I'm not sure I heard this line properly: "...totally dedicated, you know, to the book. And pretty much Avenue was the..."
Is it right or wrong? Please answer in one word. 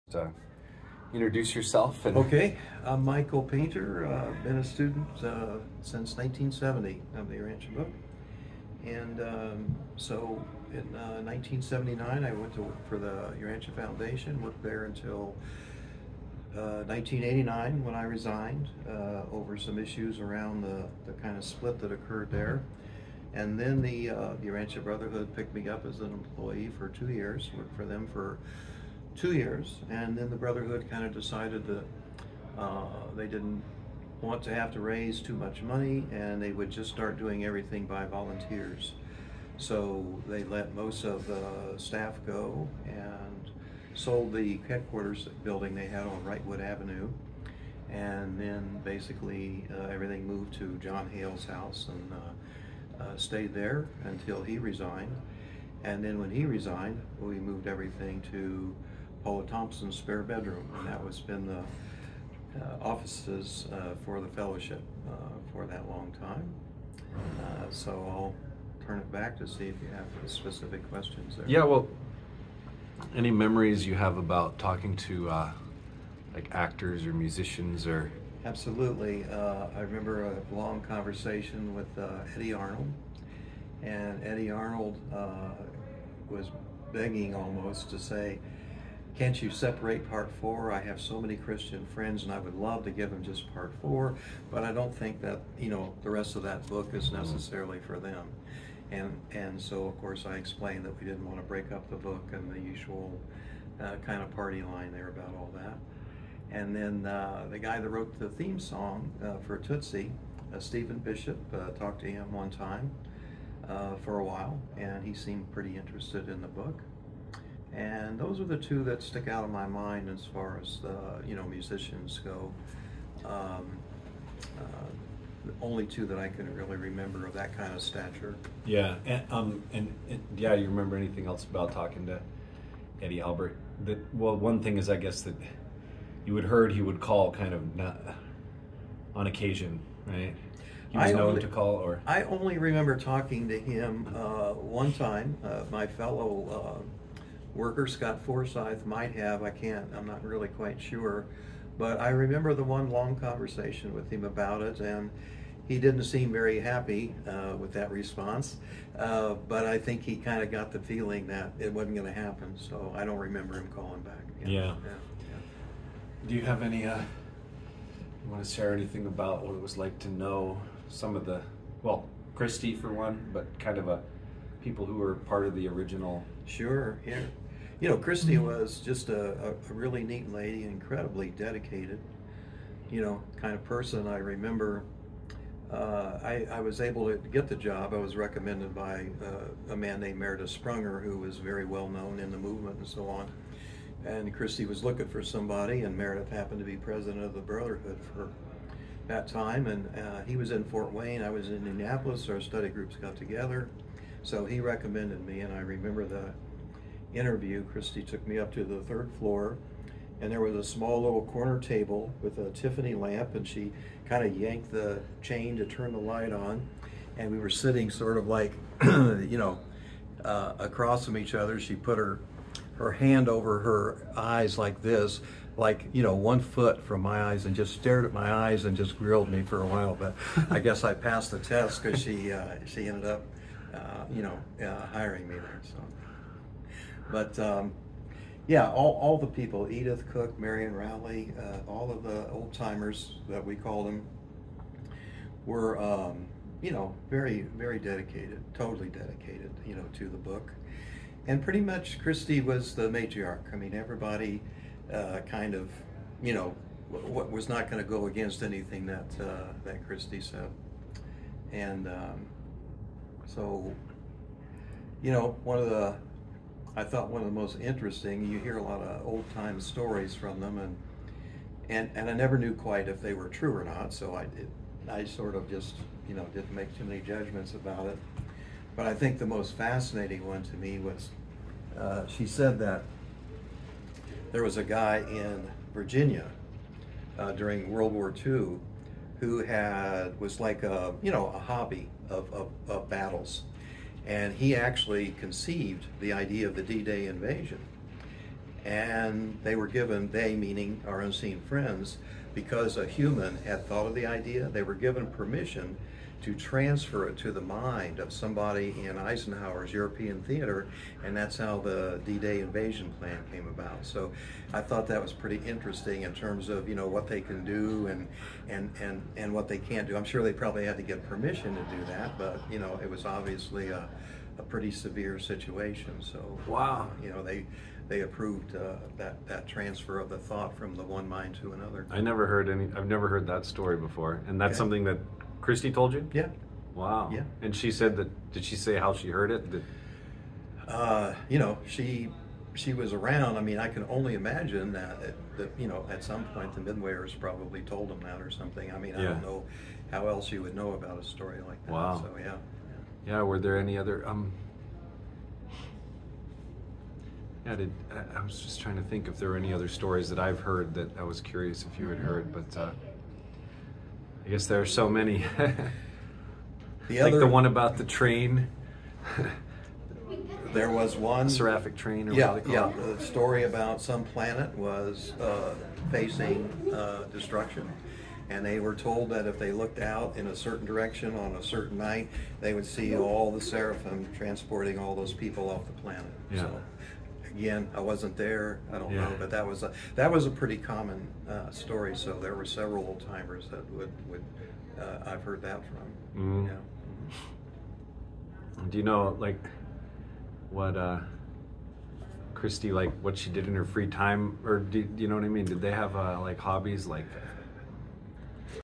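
wrong.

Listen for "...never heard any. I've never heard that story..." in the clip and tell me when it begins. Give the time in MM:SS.
05:31.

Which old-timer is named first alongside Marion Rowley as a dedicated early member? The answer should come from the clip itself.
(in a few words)
Edith Cook.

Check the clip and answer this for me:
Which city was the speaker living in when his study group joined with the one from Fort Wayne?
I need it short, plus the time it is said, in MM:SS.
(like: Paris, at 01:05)
Indianapolis, at 03:21.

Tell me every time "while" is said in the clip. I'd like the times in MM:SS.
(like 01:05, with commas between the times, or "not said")
01:54, 03:49.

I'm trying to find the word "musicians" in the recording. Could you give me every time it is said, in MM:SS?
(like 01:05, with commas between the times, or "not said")
01:17, 02:01.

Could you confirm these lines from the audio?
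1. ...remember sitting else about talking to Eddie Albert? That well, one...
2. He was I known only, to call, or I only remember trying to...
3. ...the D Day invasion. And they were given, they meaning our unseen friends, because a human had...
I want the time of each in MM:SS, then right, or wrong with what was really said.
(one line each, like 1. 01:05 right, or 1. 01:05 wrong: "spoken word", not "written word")
1. 02:10 wrong: "anything", not "sitting"
2. 02:20 wrong: "talking", not "trying"
3. 04:56 right.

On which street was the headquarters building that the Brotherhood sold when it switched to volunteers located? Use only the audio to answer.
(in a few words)
Wrightwood Avenue.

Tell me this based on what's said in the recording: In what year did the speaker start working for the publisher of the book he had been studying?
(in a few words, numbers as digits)
1979.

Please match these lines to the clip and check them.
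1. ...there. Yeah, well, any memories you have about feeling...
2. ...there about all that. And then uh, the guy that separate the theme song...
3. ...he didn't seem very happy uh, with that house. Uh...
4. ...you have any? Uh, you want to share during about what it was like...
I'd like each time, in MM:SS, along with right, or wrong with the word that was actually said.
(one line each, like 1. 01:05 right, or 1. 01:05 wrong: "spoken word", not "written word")
1. 01:11 wrong: "talking", not "feeling"
2. 01:44 wrong: "wrote", not "separate"
3. 02:35 wrong: "response", not "house"
4. 02:46 wrong: "anything", not "during".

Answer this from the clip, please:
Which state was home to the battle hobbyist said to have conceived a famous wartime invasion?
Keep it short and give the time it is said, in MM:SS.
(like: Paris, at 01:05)
Virginia, at 04:45.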